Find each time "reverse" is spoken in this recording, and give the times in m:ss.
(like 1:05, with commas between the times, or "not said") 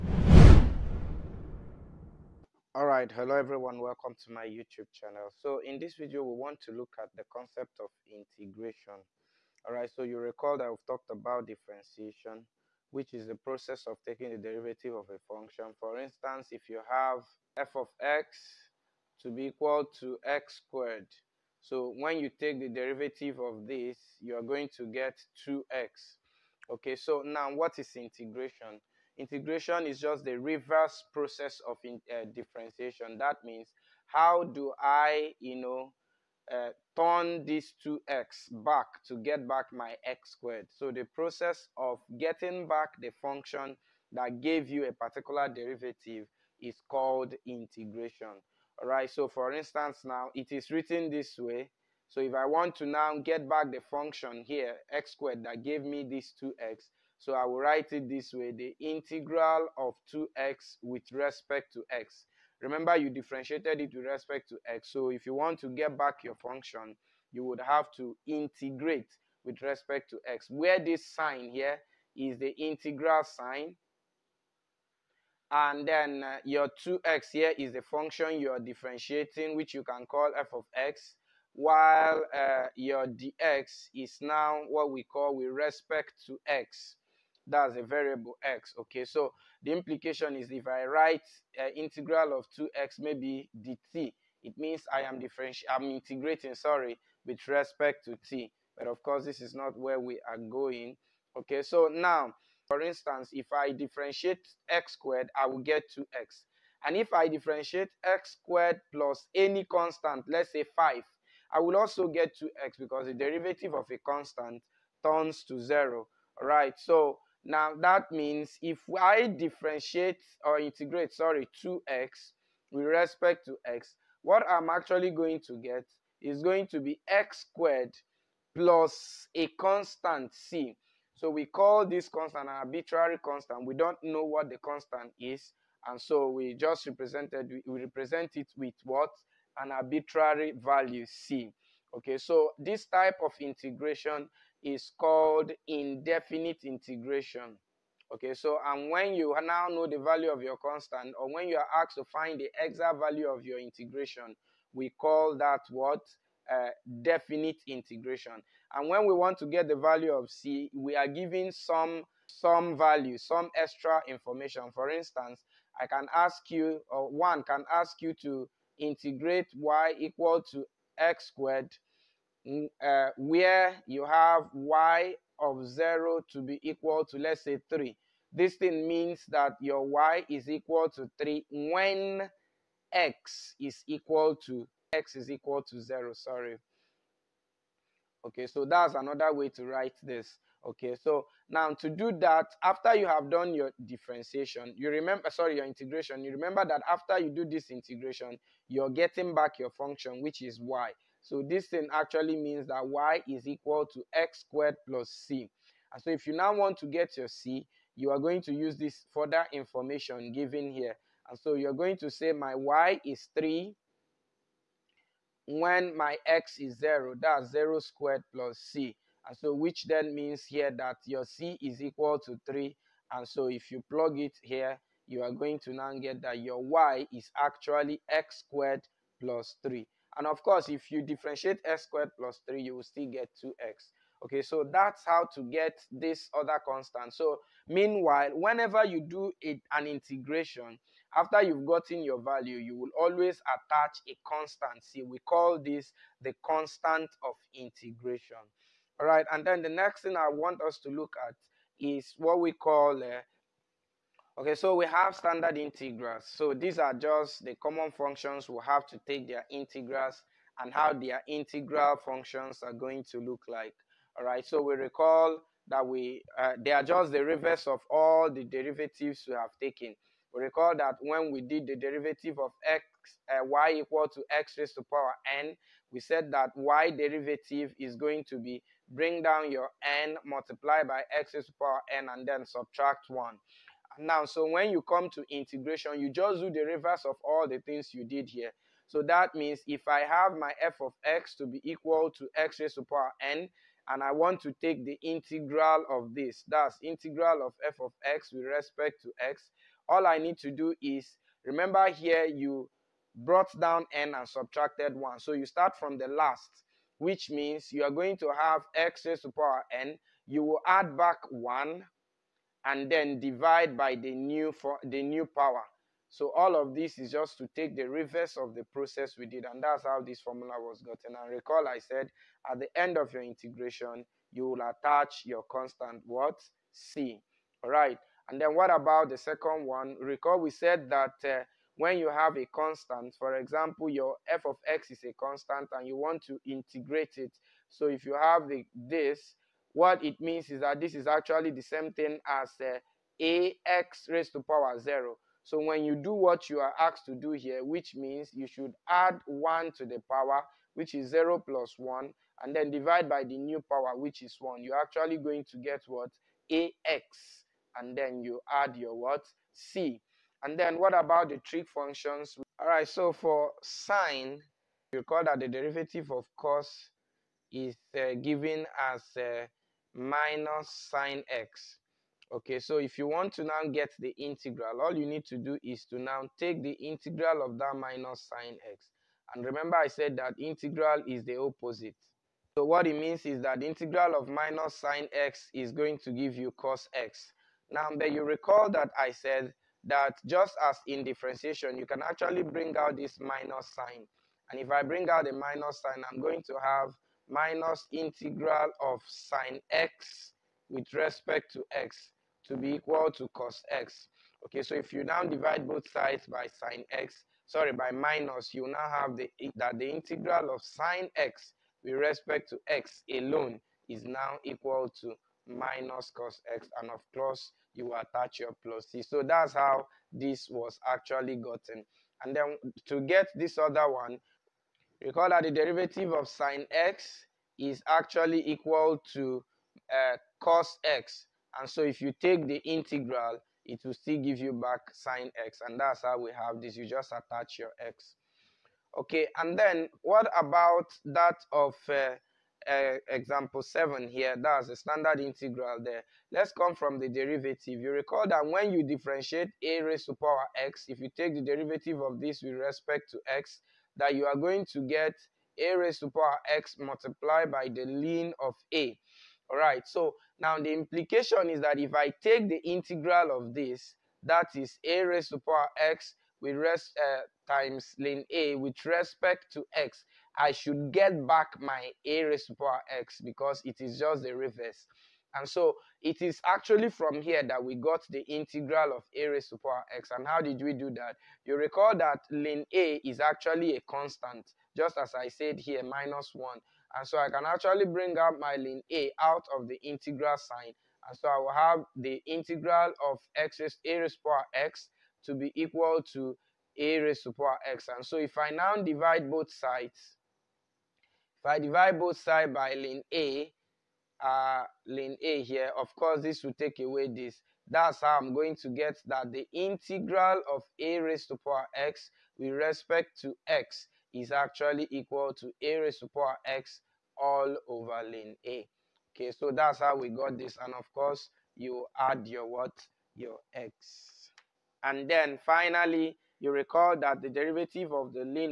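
0:30, 4:27, 4:46, 5:17, 7:54.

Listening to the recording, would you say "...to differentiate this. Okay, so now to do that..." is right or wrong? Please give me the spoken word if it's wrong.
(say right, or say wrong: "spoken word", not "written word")
wrong: "write", not "differentiate".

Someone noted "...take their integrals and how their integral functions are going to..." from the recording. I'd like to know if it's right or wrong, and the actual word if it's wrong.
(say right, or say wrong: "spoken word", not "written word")
right.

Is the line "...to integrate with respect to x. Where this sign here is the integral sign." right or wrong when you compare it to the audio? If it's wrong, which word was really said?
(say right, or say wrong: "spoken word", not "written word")
right.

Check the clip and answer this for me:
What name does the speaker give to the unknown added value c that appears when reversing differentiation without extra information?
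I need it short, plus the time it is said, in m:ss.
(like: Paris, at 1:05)
arbitrary constant, at 2:12.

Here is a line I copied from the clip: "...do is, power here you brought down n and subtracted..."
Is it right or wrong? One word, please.
wrong.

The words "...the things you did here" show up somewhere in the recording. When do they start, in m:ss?
4:47.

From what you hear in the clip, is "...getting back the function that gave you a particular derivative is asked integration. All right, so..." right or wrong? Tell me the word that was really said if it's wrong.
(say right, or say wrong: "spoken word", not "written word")
wrong: "called", not "asked".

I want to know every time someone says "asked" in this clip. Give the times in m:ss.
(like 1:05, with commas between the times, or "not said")
2:31, 5:46.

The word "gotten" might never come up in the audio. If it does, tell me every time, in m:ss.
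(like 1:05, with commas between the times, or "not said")
4:01, 5:20, 7:01.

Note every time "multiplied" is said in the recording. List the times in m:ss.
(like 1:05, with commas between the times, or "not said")
4:40, 7:36.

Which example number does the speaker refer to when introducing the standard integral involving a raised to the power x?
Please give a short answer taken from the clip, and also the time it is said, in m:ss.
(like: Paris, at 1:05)
7, at 7:23.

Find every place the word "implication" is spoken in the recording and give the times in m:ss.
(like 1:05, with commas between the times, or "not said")
1:29, 7:40.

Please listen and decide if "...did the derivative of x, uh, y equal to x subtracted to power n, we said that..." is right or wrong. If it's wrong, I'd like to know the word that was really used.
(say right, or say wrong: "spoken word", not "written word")
wrong: "raised", not "subtracted".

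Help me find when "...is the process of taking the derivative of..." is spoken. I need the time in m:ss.
0:13.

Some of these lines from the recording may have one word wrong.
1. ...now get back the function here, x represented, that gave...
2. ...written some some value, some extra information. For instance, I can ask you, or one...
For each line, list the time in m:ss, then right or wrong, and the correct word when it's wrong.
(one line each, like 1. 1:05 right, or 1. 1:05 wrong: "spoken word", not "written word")
1. 0:52 wrong: "squared", not "represented"
2. 2:41 wrong: "given", not "written".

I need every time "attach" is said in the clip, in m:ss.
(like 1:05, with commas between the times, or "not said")
4:03, 5:24, 6:57, 7:17.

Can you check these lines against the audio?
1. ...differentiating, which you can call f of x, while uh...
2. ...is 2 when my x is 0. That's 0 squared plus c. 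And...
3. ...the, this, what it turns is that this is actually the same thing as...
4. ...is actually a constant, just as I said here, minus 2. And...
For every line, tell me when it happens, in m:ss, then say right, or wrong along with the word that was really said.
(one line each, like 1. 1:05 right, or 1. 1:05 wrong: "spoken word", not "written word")
1. 1:18 right
2. 3:33 wrong: "3", not "2"
3. 5:38 wrong: "means", not "turns"
4. 8:03 wrong: "1", not "2".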